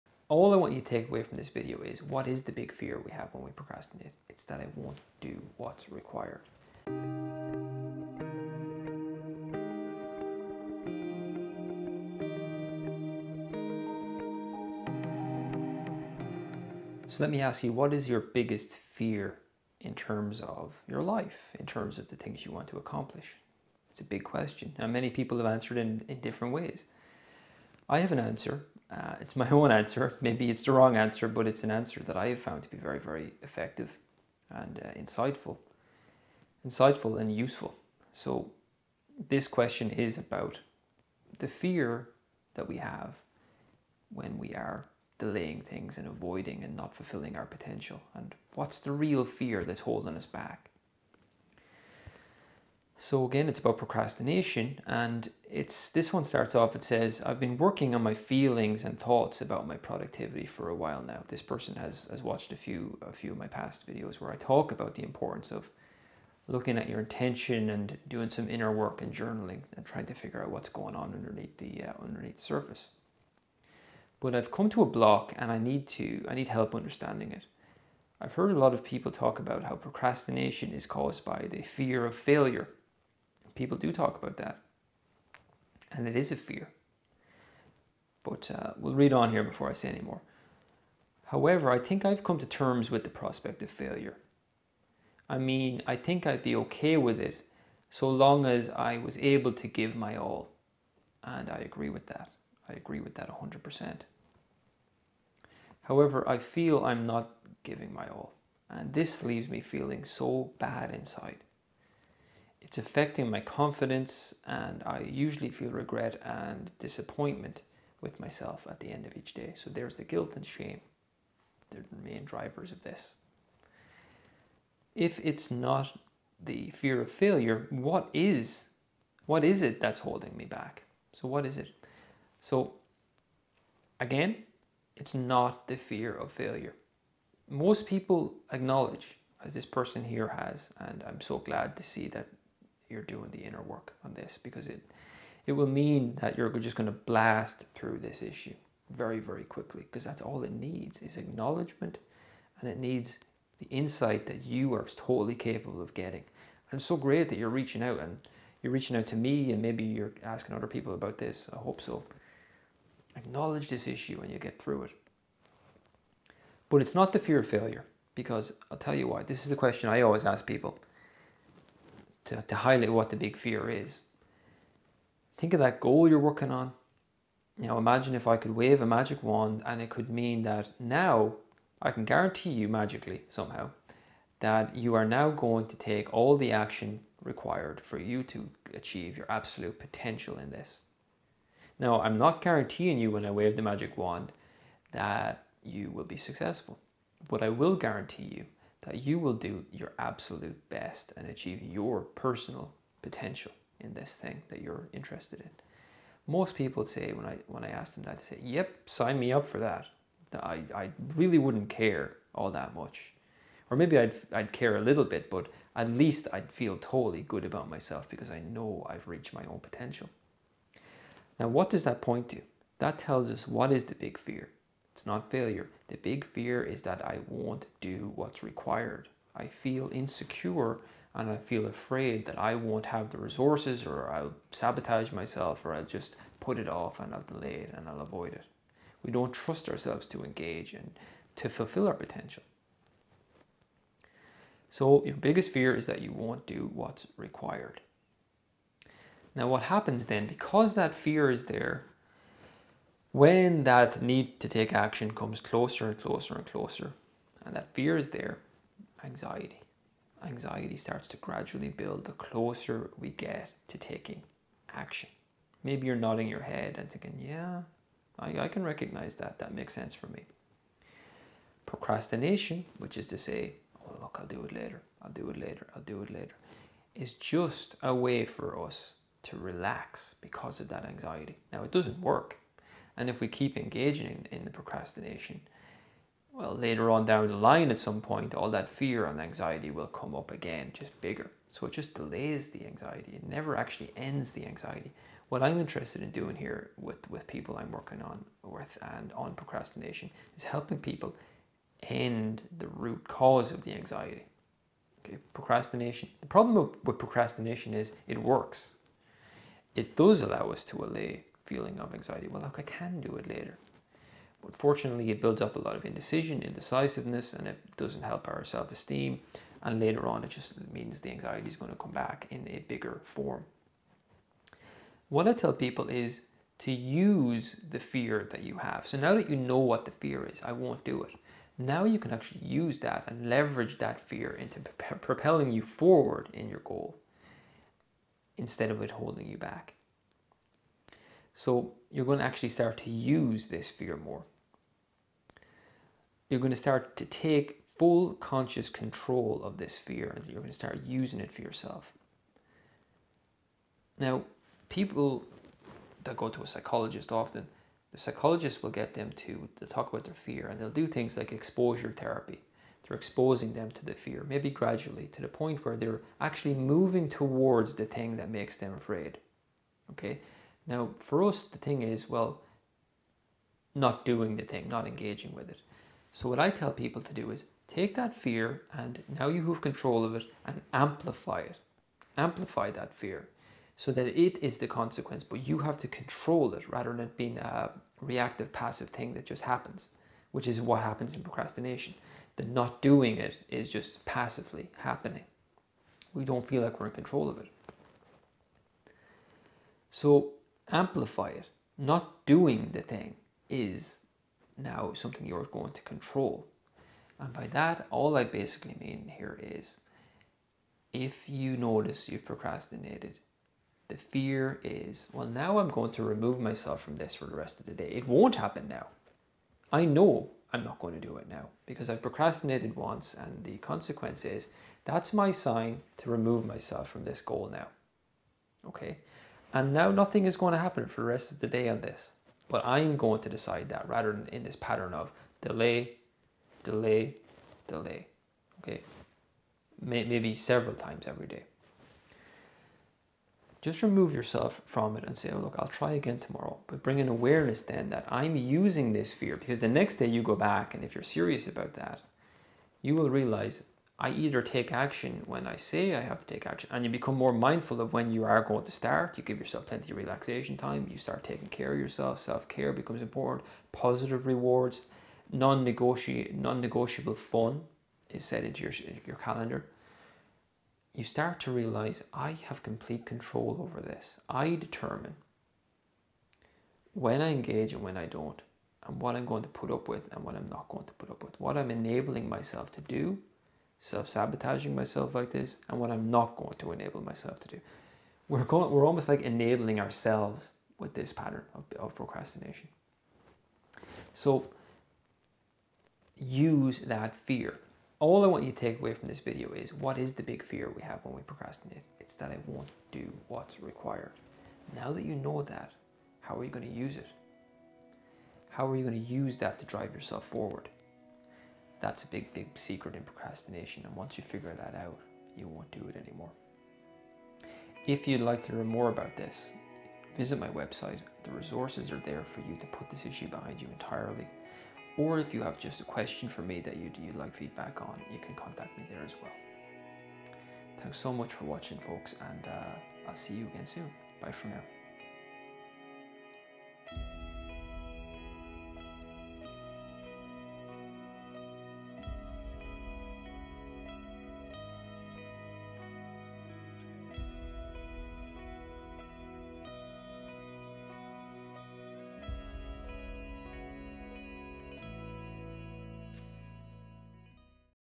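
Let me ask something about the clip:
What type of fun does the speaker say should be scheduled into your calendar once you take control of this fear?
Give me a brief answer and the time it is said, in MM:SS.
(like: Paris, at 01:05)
Non negotiable fun, at 07:45.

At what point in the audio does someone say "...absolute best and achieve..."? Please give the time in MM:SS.
03:19.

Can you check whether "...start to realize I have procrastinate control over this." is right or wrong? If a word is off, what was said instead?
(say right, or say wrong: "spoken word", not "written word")
wrong: "complete", not "procrastinate".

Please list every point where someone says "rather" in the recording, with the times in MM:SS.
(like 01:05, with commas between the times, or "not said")
06:26, 07:13.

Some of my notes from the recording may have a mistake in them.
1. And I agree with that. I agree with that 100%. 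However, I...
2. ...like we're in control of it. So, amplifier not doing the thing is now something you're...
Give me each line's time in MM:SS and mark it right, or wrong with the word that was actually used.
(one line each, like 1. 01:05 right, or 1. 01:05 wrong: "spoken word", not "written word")
1. 01:41 right
2. 06:36 right.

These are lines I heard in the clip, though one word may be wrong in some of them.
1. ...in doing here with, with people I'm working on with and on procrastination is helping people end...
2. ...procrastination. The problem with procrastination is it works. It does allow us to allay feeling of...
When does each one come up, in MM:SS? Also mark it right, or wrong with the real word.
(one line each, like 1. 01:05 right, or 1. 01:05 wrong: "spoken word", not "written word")
1. 04:56 right
2. 05:05 right.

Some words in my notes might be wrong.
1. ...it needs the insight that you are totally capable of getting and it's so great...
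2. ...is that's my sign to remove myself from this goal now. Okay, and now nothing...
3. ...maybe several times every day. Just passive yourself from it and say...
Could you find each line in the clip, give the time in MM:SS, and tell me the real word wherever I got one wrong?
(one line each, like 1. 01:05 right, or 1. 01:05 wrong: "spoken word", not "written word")
1. 02:32 right
2. 07:04 right
3. 07:19 wrong: "remove", not "passive".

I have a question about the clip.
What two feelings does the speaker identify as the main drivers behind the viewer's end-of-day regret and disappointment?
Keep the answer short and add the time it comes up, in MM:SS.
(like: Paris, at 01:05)
Guilt and shame, at 02:00.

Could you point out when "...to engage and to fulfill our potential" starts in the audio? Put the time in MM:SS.
04:00.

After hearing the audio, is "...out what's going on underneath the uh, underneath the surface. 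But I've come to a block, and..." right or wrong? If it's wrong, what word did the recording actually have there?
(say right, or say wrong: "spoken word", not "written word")
right.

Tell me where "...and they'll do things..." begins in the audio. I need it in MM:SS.
06:00.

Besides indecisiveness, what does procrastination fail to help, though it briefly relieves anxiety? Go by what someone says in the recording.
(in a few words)
Self esteem.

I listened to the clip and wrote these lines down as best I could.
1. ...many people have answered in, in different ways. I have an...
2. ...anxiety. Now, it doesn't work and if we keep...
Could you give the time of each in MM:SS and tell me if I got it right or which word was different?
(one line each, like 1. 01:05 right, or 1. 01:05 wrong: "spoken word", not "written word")
1. 00:24 right
2. 04:40 right.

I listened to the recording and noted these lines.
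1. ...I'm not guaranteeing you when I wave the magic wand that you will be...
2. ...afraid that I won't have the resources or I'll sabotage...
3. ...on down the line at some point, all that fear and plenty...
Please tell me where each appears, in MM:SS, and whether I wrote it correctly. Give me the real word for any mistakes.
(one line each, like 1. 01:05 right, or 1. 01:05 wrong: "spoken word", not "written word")
1. 03:12 right
2. 03:51 right
3. 04:46 wrong: "anxiety", not "plenty".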